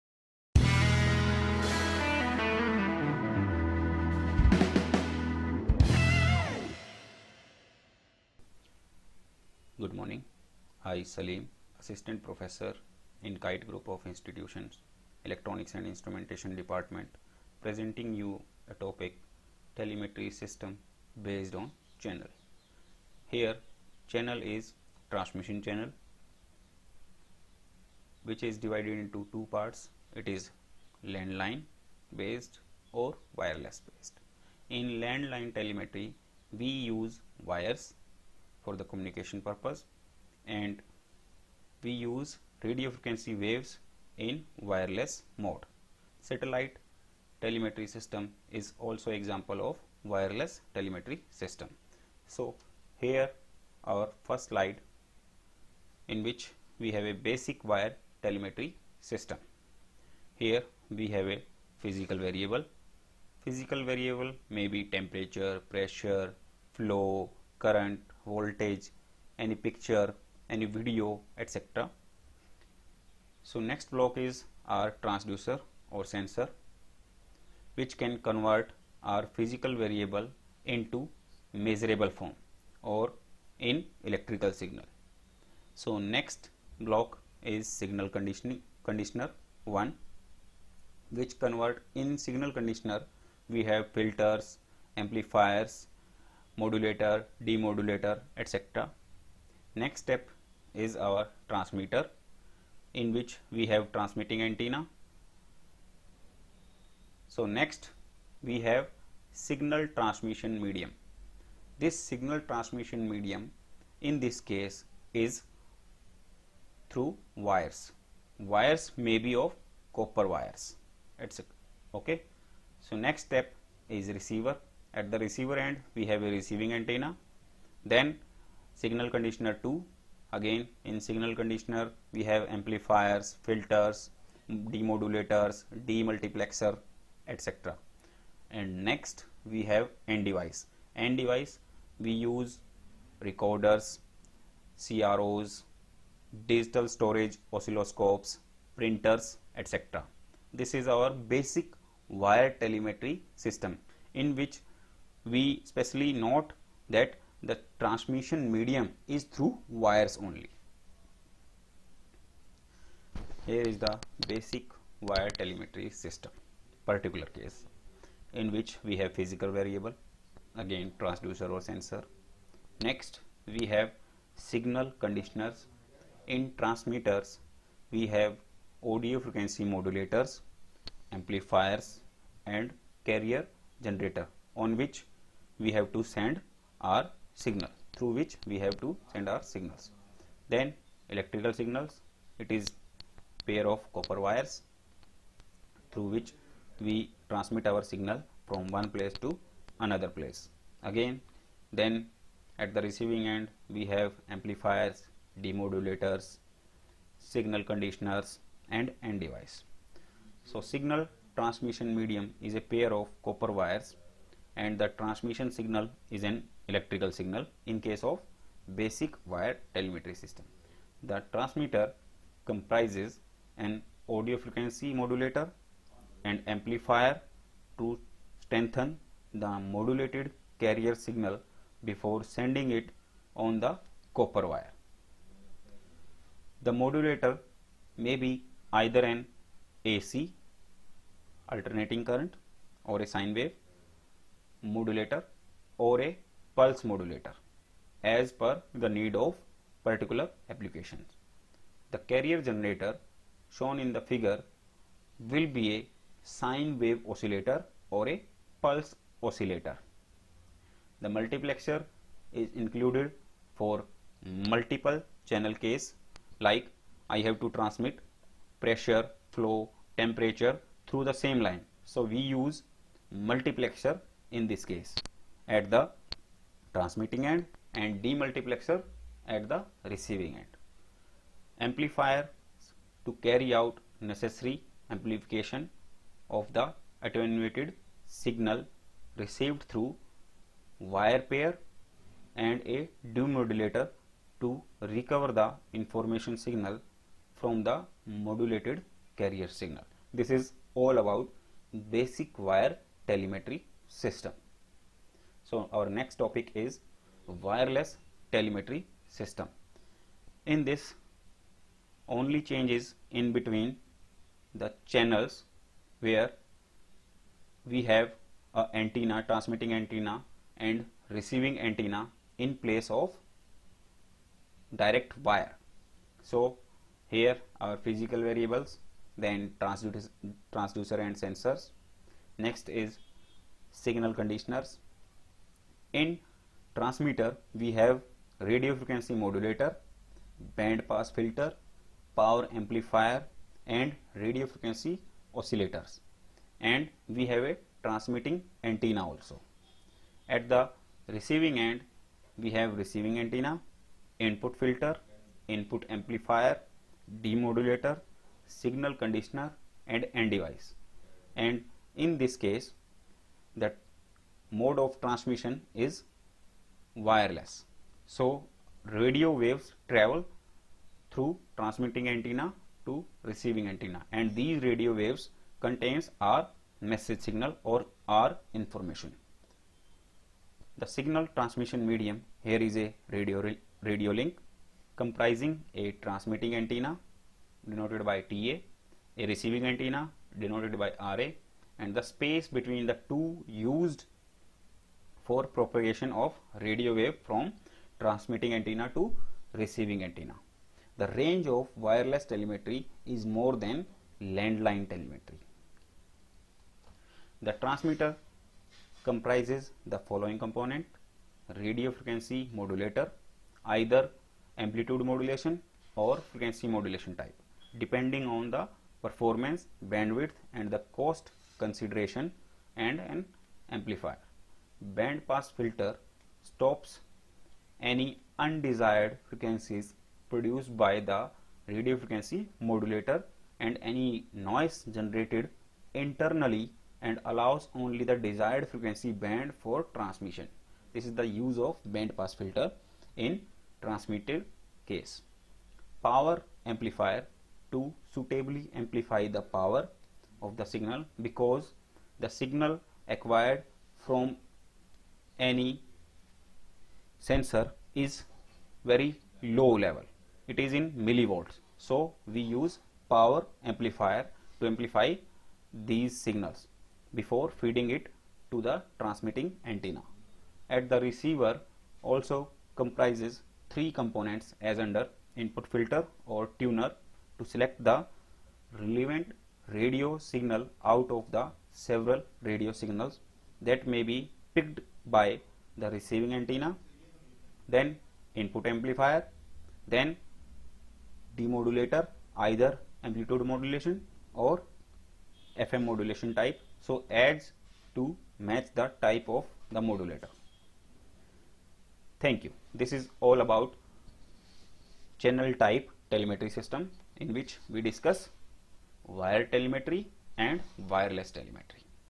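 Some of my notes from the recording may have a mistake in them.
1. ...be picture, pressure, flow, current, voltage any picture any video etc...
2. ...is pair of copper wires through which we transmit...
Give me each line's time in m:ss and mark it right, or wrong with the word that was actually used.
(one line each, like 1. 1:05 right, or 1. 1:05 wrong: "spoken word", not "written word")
1. 1:04 wrong: "temperature", not "picture"
2. 3:12 right.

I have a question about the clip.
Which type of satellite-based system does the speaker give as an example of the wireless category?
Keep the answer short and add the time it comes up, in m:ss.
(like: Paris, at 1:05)
Satellite telemetry system, at 0:46.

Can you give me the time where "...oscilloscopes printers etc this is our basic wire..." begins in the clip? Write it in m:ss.
2:27.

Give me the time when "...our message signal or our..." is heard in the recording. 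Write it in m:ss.
6:16.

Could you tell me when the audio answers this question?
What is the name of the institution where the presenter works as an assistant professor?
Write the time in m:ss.
0:13.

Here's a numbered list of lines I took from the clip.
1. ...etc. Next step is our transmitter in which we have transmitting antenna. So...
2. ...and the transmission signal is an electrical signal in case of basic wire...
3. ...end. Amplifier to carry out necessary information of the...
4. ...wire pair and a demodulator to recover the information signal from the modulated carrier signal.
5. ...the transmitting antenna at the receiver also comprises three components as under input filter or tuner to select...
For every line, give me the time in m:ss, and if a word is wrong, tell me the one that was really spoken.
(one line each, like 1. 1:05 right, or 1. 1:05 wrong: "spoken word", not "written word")
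1. 1:38 right
2. 3:34 right
3. 4:40 wrong: "amplification", not "information"
4. 4:50 right
5. 7:48 right.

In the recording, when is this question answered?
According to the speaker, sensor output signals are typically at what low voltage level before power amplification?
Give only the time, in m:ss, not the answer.
7:41.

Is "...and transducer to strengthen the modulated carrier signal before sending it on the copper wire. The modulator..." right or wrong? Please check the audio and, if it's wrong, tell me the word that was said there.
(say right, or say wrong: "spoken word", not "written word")
wrong: "amplifier", not "transducer".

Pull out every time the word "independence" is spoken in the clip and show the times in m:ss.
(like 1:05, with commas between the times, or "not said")
not said.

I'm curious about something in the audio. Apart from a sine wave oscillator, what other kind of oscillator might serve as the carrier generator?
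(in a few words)
Pulse oscillator.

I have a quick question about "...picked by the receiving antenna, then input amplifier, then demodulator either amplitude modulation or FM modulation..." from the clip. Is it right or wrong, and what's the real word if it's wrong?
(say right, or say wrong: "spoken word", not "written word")
right.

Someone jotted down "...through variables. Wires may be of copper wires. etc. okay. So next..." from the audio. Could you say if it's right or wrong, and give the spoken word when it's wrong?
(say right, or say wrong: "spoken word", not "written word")
wrong: "wires", not "variables".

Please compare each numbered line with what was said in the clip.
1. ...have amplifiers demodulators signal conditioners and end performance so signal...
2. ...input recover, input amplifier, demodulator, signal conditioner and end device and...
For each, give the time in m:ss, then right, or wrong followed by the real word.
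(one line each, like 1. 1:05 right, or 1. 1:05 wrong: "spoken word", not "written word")
1. 3:23 wrong: "device", not "performance"
2. 5:54 wrong: "filter", not "recover".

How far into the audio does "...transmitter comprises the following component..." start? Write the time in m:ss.
6:47.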